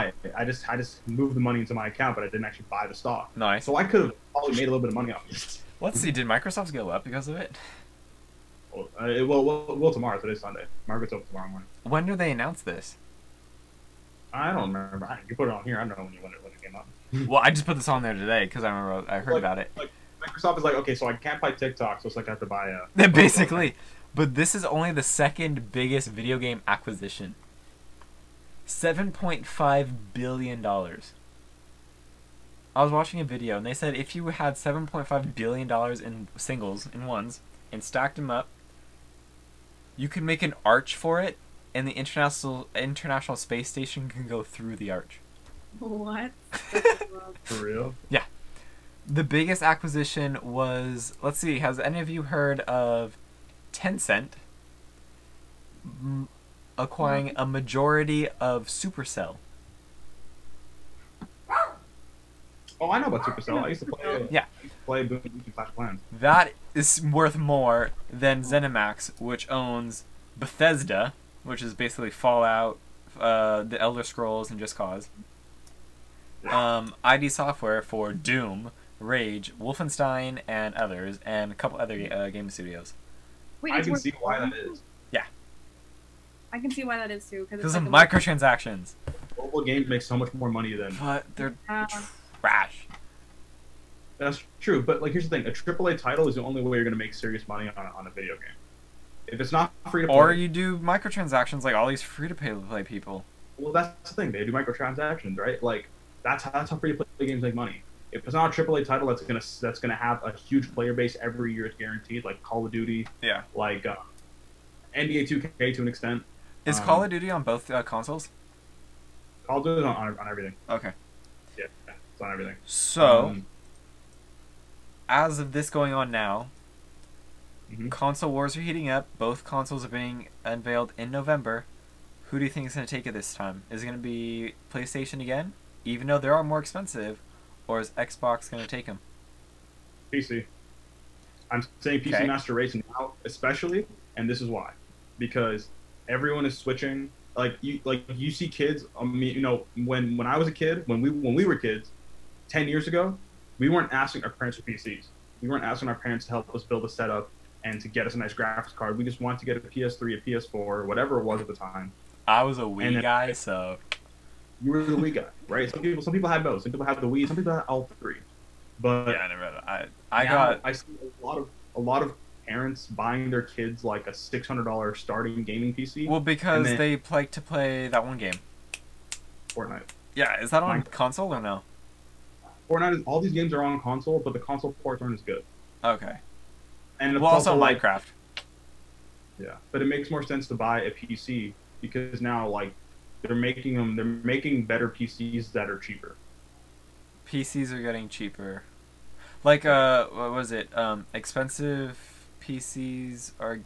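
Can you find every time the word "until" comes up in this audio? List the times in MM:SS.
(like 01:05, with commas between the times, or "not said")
not said.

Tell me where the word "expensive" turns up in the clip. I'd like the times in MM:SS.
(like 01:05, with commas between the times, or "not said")
02:16, 03:21.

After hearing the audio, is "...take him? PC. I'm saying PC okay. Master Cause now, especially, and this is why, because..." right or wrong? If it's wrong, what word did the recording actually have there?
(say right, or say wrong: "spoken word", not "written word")
wrong: "Race", not "Cause".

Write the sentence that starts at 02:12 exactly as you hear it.
Who do you think is going to take it this time?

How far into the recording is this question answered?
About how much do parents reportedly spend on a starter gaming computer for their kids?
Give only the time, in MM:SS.
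02:54.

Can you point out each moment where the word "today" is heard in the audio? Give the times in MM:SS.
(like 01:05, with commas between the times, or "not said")
00:10, 00:18.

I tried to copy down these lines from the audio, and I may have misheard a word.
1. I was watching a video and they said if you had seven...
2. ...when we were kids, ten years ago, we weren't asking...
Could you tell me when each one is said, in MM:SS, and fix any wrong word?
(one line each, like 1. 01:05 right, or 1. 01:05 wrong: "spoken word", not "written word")
1. 00:32 right
2. 02:31 right.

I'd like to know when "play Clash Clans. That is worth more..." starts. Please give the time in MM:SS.
01:04.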